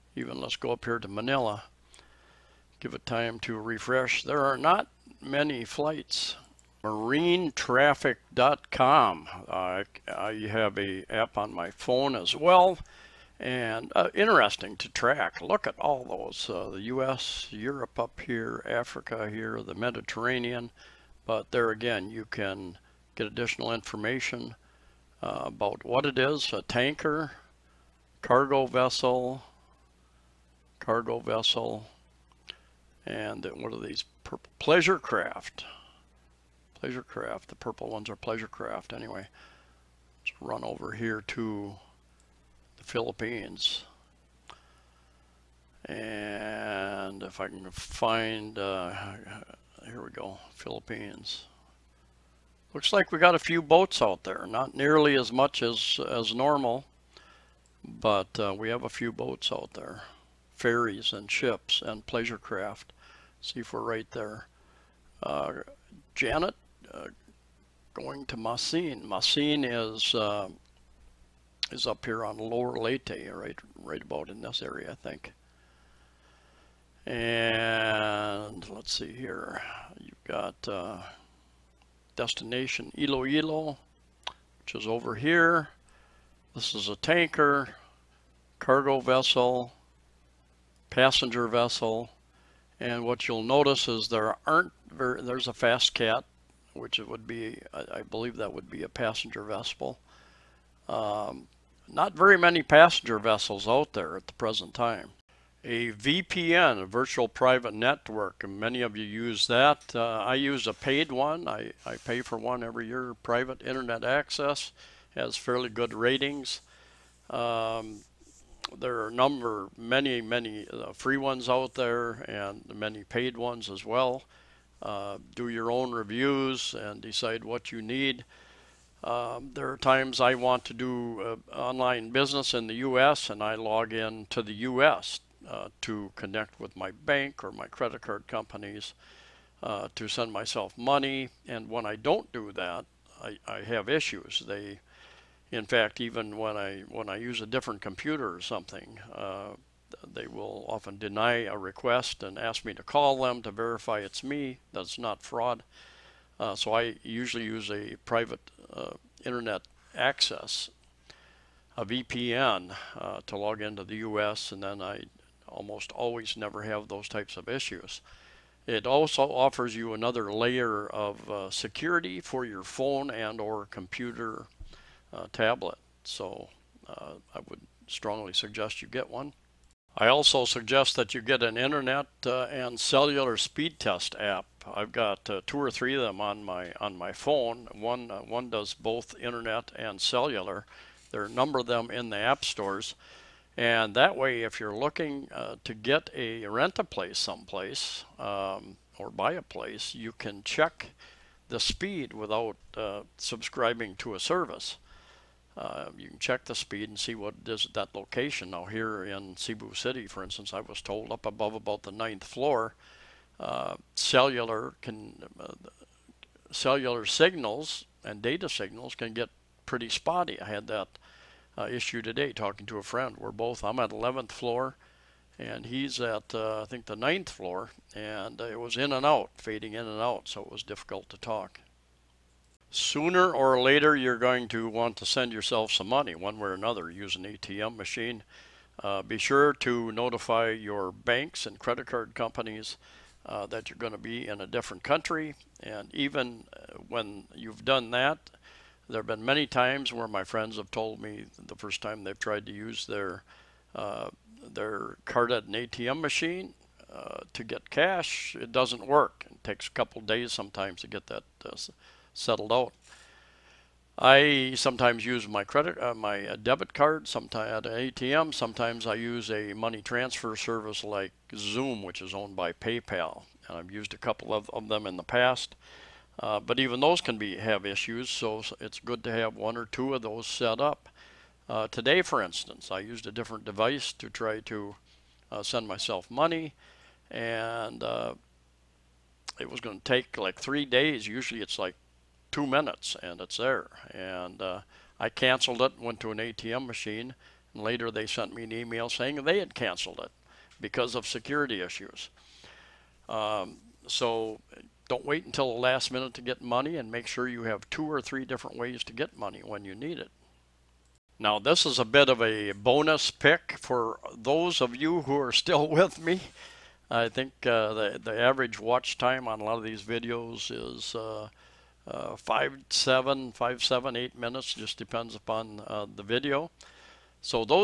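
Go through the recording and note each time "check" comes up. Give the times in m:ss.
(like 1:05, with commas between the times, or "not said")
3:20, 3:26.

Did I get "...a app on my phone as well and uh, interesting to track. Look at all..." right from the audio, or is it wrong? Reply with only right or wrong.
right.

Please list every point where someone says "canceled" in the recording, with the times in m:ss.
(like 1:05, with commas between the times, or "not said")
4:55, 4:59.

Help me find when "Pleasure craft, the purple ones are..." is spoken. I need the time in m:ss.
0:36.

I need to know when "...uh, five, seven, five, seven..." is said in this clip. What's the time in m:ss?
5:21.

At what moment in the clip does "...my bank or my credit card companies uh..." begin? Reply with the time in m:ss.
2:16.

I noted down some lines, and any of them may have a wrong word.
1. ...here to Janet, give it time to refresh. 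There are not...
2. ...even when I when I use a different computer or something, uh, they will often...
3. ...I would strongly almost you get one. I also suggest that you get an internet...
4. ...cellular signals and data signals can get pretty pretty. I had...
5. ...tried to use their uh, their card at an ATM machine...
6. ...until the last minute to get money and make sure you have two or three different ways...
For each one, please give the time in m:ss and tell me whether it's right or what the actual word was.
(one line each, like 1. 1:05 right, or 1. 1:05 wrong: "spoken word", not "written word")
1. 0:00 wrong: "Manila", not "Janet"
2. 2:25 right
3. 2:57 wrong: "suggest", not "almost"
4. 3:36 wrong: "spotty", not "pretty"
5. 4:12 right
6. 5:05 right.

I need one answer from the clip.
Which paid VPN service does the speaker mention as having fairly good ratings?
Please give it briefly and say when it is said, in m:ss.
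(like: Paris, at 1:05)
Private Internet Access, at 1:53.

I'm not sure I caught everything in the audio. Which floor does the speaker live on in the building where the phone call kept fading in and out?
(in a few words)
11th floor.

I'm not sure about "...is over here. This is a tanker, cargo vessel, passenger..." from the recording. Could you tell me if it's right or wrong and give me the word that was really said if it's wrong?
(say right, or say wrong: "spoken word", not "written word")
right.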